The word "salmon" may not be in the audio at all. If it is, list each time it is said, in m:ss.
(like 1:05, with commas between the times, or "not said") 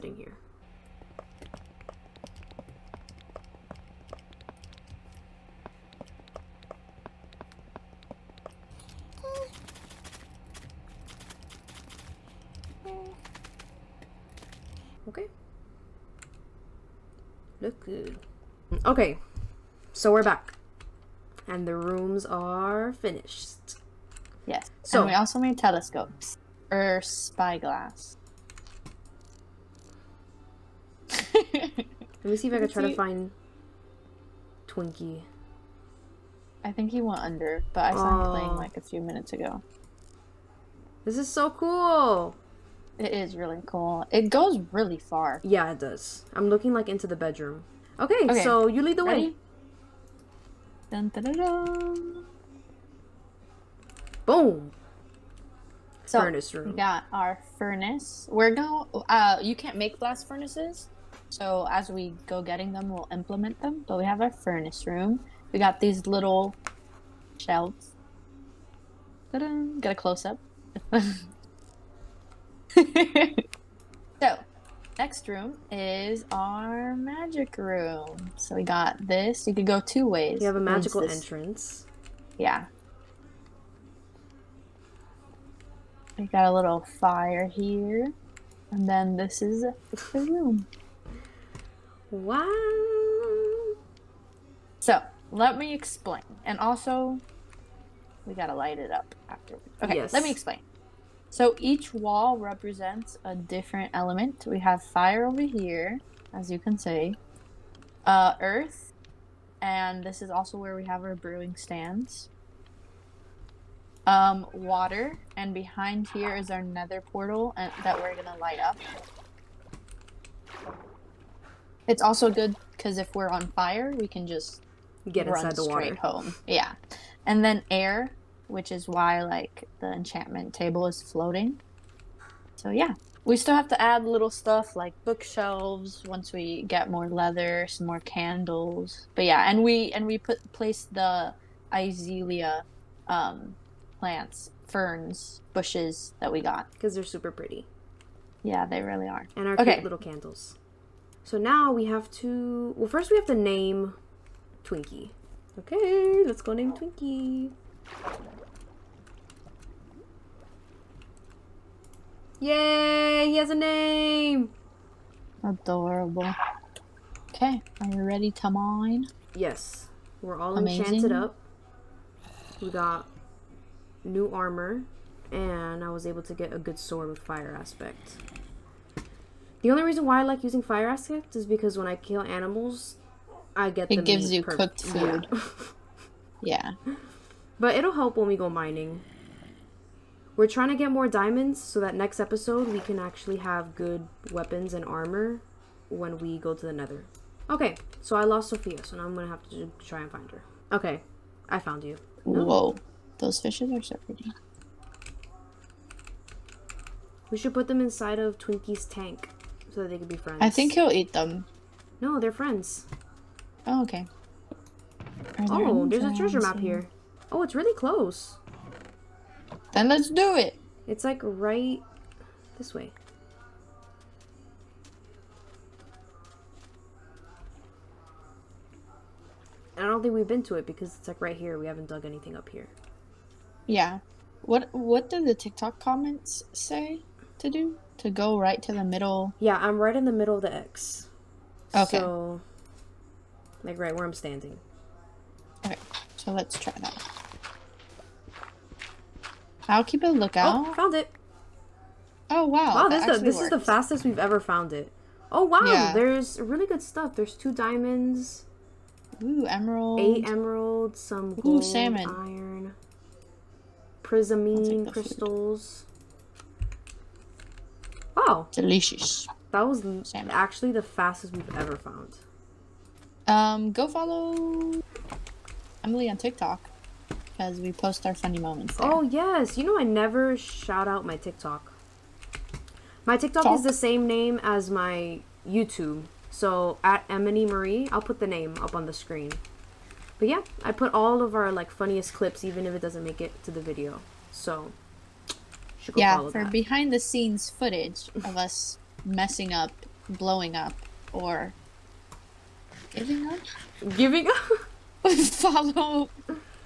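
4:21, 4:30.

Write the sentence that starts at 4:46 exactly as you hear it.
So at Emily Marie, I'll put the name up on the screen.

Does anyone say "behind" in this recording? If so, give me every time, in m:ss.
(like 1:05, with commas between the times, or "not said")
1:55, 4:56.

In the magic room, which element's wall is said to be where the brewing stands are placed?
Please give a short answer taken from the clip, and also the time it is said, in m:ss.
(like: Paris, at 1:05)
Earth, at 1:48.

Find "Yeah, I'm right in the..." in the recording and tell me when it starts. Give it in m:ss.
3:59.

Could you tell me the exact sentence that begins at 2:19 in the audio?
But yeah, and we and we put place the azalea um, plants, ferns, bushes that we got because they're super pretty.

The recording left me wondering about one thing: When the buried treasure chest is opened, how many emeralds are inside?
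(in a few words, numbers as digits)
8.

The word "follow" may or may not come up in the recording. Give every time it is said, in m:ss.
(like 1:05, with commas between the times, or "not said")
4:33, 5:05.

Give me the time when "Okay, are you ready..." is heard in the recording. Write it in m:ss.
2:47.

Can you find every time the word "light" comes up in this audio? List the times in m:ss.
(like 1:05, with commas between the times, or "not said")
1:38, 1:58.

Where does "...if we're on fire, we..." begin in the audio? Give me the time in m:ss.
2:02.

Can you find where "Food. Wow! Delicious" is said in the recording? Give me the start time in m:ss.
4:26.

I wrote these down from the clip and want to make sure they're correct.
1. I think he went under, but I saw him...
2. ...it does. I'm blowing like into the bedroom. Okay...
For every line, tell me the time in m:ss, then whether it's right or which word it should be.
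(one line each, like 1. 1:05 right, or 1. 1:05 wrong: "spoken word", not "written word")
1. 0:36 right
2. 0:45 wrong: "looking", not "blowing".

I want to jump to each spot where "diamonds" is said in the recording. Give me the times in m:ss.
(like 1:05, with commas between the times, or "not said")
3:11, 4:17.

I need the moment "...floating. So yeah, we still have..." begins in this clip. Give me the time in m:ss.
2:11.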